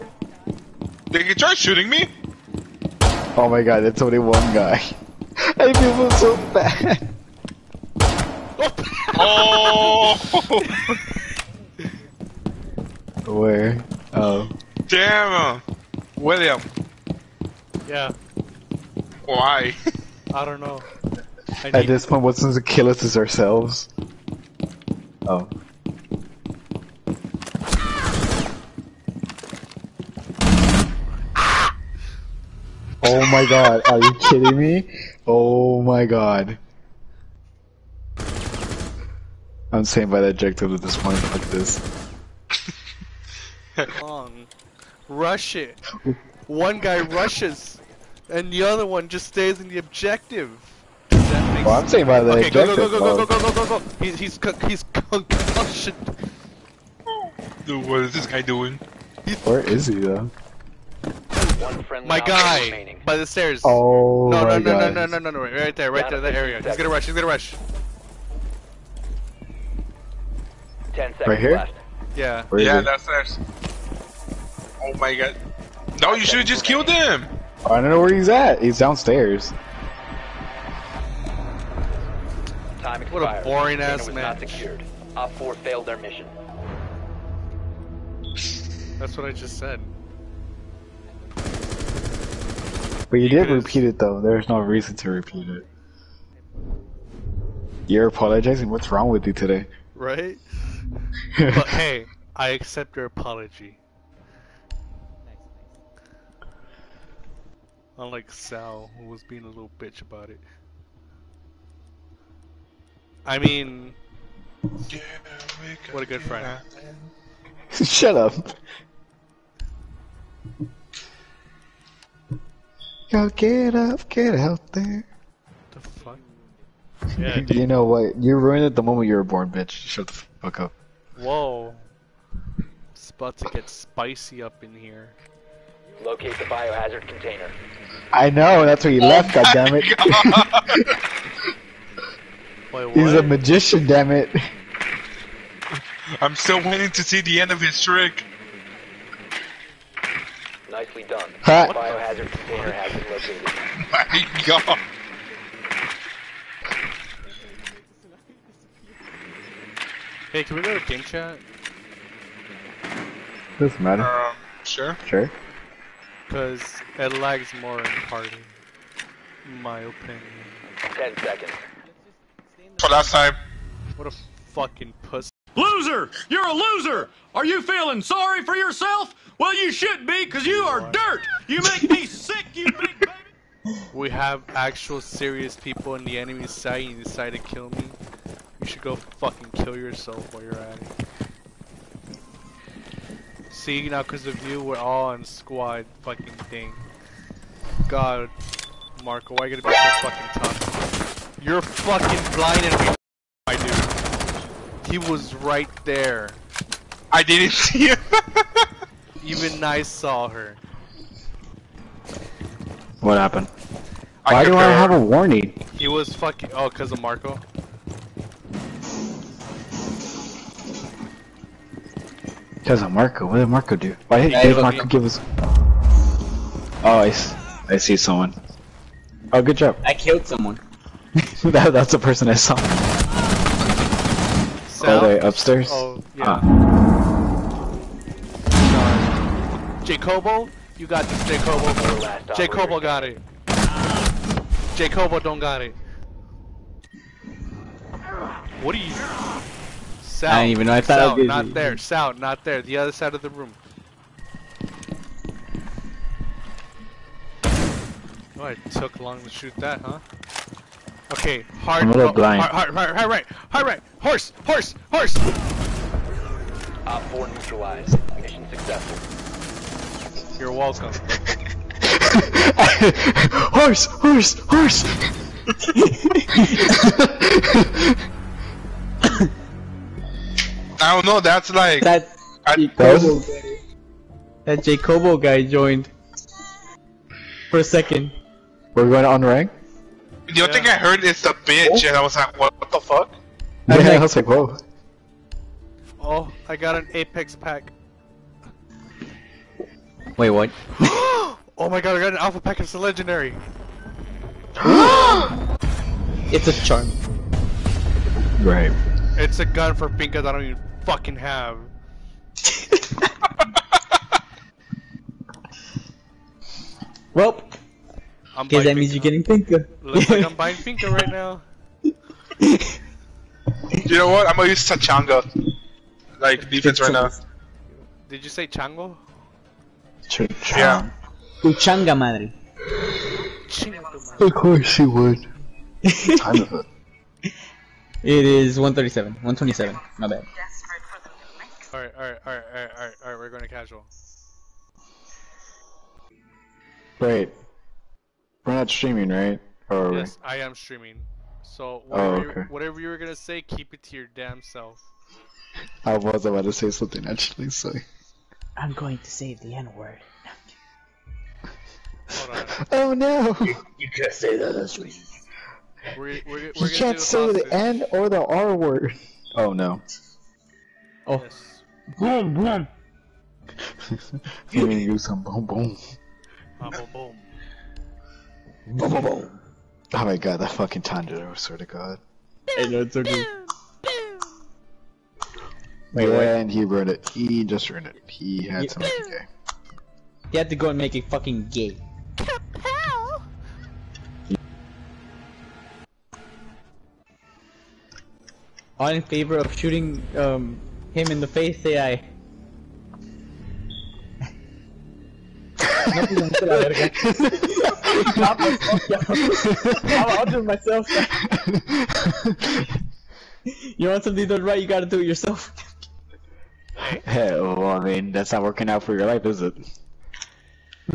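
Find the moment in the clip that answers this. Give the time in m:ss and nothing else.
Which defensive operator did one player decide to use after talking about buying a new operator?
5:24.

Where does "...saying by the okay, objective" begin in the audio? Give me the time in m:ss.
0:51.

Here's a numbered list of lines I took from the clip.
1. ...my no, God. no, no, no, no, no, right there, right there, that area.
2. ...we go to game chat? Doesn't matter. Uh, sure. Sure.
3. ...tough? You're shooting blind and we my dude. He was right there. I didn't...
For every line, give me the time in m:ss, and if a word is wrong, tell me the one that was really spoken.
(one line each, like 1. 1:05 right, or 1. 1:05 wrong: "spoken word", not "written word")
1. 1:04 right
2. 2:40 right
3. 3:20 wrong: "fucking", not "shooting".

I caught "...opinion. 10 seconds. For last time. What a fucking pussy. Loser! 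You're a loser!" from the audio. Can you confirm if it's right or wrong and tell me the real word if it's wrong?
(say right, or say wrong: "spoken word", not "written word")
right.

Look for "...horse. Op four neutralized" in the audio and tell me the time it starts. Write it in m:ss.
4:24.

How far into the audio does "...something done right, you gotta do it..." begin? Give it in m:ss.
6:54.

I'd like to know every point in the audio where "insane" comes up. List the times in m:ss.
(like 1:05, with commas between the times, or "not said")
not said.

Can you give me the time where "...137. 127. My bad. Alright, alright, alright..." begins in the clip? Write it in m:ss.
5:38.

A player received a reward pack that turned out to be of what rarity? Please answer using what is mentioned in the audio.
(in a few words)
Legendary.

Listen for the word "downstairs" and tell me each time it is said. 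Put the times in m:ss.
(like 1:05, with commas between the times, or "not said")
1:12, 1:18.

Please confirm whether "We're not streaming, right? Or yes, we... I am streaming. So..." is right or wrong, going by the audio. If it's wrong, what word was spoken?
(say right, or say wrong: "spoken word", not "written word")
right.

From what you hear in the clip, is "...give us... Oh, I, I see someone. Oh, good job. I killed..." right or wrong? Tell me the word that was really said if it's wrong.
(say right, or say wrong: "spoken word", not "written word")
right.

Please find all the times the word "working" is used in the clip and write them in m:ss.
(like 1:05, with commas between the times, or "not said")
6:58.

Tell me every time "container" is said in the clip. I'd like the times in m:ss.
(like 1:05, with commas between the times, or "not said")
2:17, 2:32.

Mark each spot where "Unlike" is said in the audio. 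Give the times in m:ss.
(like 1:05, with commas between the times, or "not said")
1:47.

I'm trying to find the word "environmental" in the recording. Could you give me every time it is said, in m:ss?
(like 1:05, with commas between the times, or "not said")
not said.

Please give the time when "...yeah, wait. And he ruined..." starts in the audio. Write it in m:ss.
6:26.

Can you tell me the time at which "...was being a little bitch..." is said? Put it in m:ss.
1:49.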